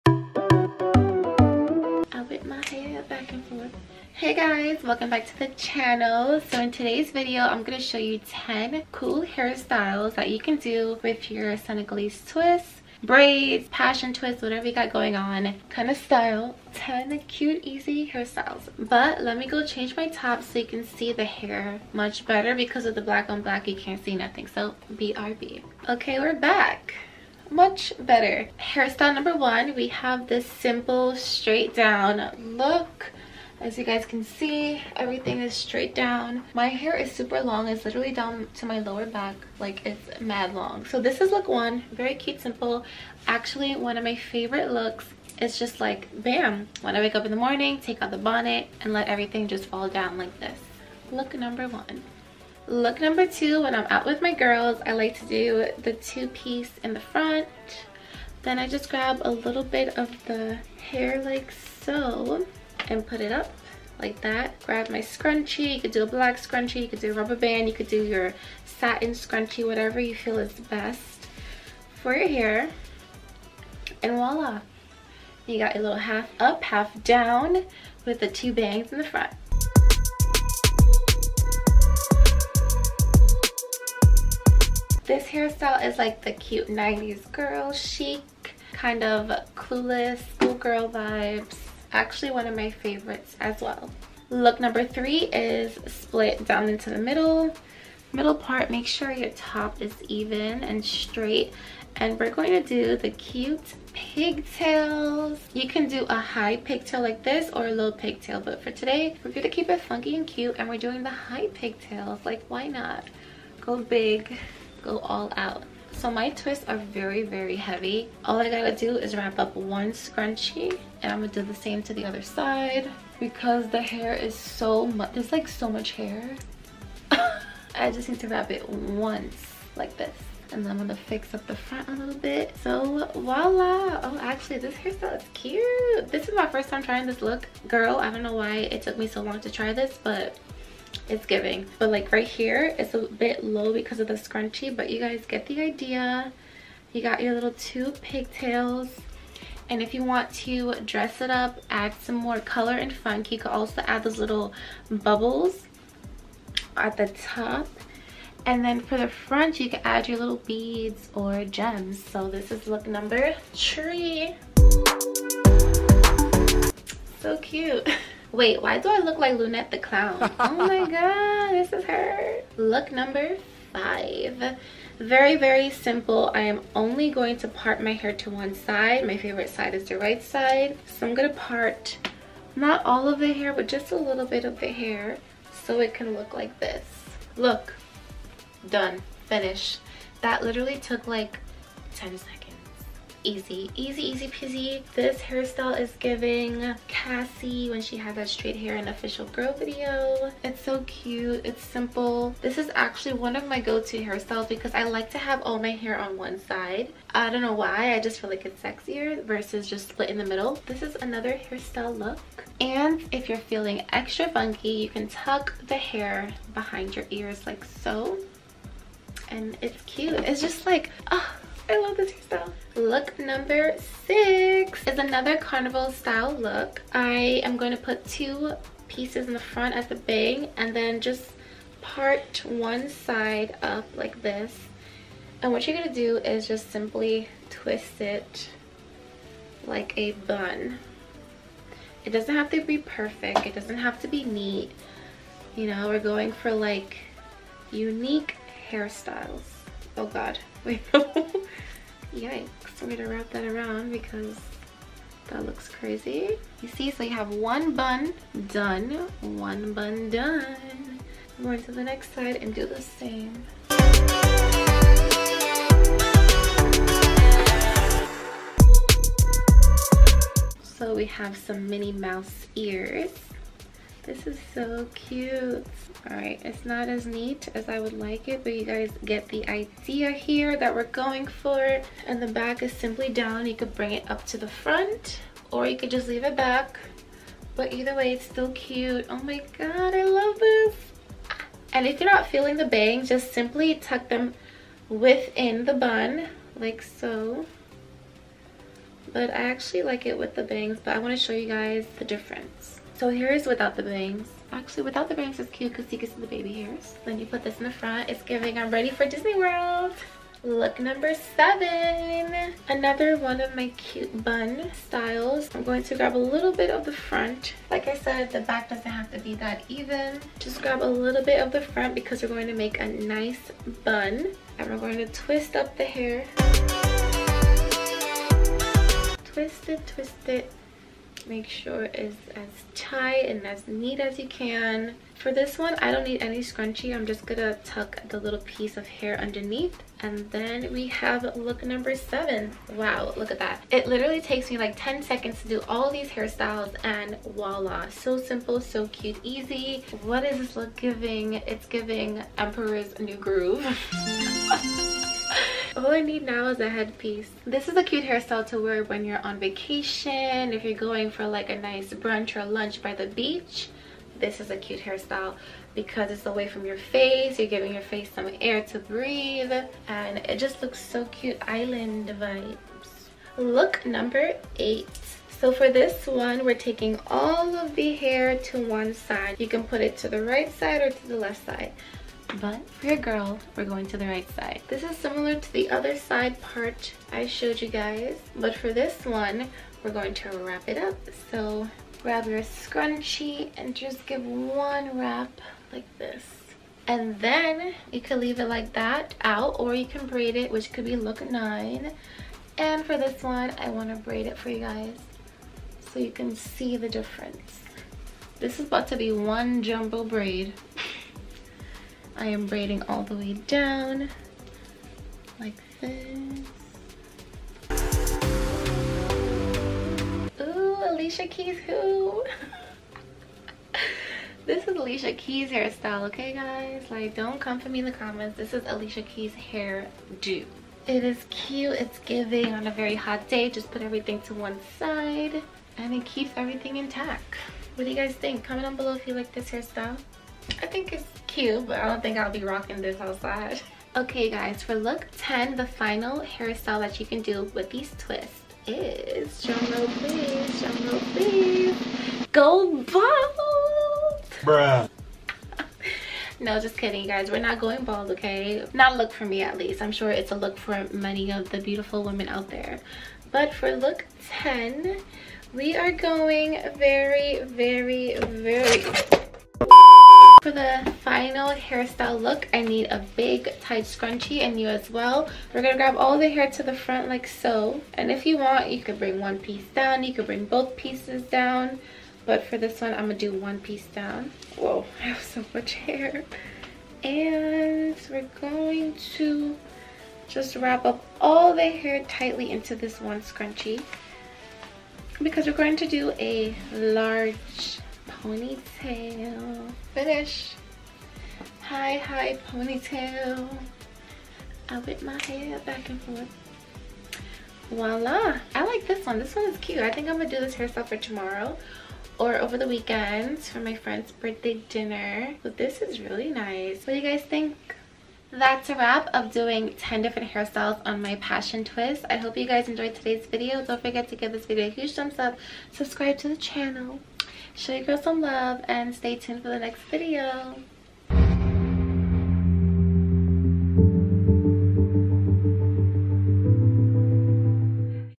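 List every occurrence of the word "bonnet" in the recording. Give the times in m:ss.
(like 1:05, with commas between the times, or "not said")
0:48.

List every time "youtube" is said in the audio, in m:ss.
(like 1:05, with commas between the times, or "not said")
not said.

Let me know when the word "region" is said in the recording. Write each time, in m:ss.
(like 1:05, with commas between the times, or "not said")
not said.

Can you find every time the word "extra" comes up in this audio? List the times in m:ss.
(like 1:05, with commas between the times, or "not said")
3:33.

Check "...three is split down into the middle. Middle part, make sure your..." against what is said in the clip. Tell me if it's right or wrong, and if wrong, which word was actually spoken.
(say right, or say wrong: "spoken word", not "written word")
right.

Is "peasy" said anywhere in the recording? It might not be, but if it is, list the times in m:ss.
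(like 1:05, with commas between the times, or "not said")
3:14.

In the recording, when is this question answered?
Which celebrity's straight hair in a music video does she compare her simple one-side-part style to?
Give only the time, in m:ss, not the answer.
3:16.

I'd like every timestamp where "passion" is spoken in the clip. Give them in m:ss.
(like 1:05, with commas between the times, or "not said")
0:13, 8:41.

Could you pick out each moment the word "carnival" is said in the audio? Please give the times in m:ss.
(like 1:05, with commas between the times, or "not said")
3:45.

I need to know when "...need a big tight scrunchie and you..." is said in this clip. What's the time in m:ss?
7:52.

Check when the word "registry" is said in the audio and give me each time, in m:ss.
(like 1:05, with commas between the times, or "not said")
not said.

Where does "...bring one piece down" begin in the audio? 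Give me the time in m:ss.
7:58.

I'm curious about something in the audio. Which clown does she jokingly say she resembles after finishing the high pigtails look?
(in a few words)
Lunette the Clown.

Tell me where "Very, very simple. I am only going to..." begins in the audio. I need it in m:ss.
2:54.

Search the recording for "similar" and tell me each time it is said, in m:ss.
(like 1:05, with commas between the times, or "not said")
6:24.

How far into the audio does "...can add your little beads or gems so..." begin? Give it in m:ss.
2:39.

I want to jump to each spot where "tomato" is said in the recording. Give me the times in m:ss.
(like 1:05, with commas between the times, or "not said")
not said.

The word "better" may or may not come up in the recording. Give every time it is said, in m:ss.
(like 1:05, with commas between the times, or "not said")
0:22, 0:27.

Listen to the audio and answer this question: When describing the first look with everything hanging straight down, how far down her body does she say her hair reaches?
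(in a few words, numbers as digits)
lower back.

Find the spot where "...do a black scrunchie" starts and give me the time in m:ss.
1:05.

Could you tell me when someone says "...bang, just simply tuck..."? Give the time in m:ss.
4:52.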